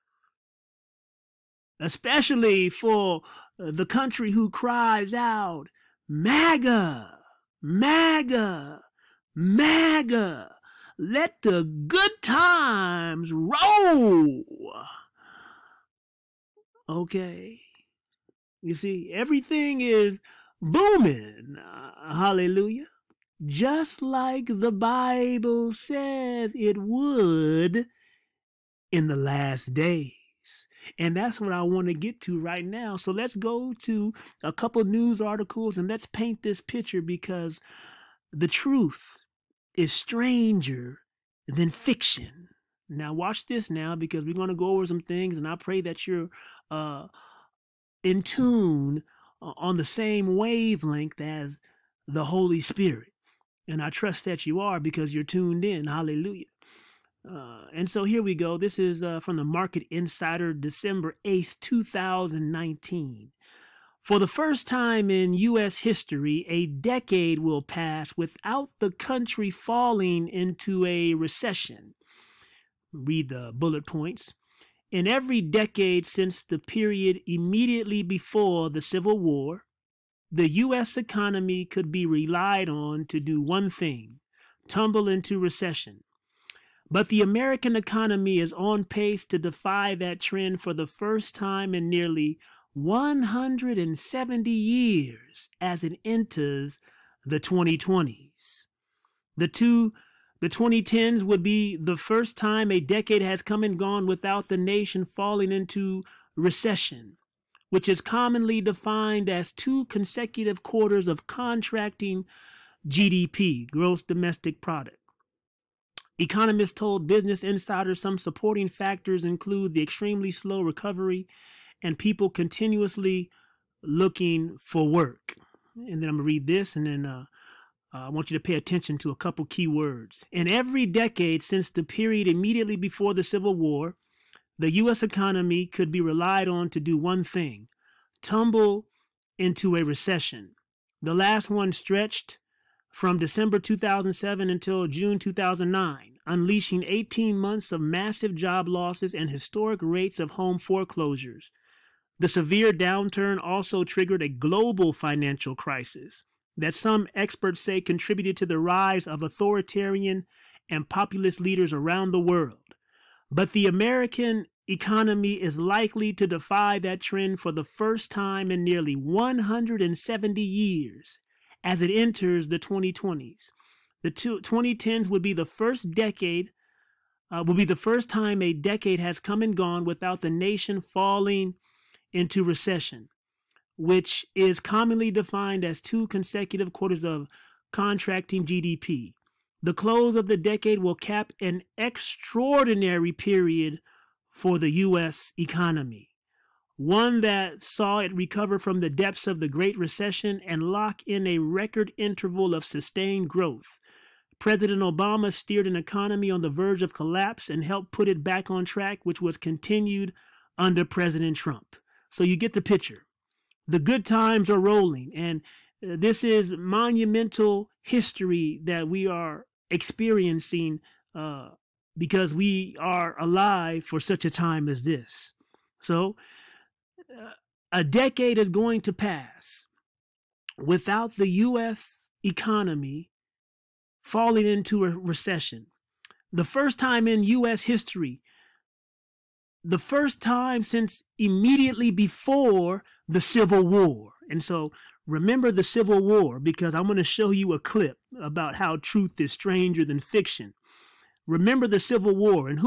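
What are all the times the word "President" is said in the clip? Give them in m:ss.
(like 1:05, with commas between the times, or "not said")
3:24, 3:30.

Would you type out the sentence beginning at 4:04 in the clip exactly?
And so remember the Civil War because I'm going to show you a clip about how truth is stranger than fiction.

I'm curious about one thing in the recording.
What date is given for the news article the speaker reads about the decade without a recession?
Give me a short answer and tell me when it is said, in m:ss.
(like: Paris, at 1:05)
December 8, 2019, at 1:00.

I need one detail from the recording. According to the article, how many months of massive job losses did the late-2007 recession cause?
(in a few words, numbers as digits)
18.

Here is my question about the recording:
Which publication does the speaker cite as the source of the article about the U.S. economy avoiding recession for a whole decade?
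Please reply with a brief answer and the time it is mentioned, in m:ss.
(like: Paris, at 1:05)
Market Insider, at 0:59.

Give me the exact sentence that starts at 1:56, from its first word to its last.
Economists told Business Insider some supporting factors include the extremely slow recovery and people continuously looking for work.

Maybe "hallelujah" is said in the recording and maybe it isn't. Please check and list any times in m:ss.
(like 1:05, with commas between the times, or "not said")
0:22, 0:55.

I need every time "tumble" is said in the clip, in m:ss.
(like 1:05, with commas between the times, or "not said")
1:24, 2:18.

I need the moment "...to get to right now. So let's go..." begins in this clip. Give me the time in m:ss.
0:31.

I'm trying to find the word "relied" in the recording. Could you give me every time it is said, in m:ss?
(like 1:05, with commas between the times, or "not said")
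1:22, 2:15.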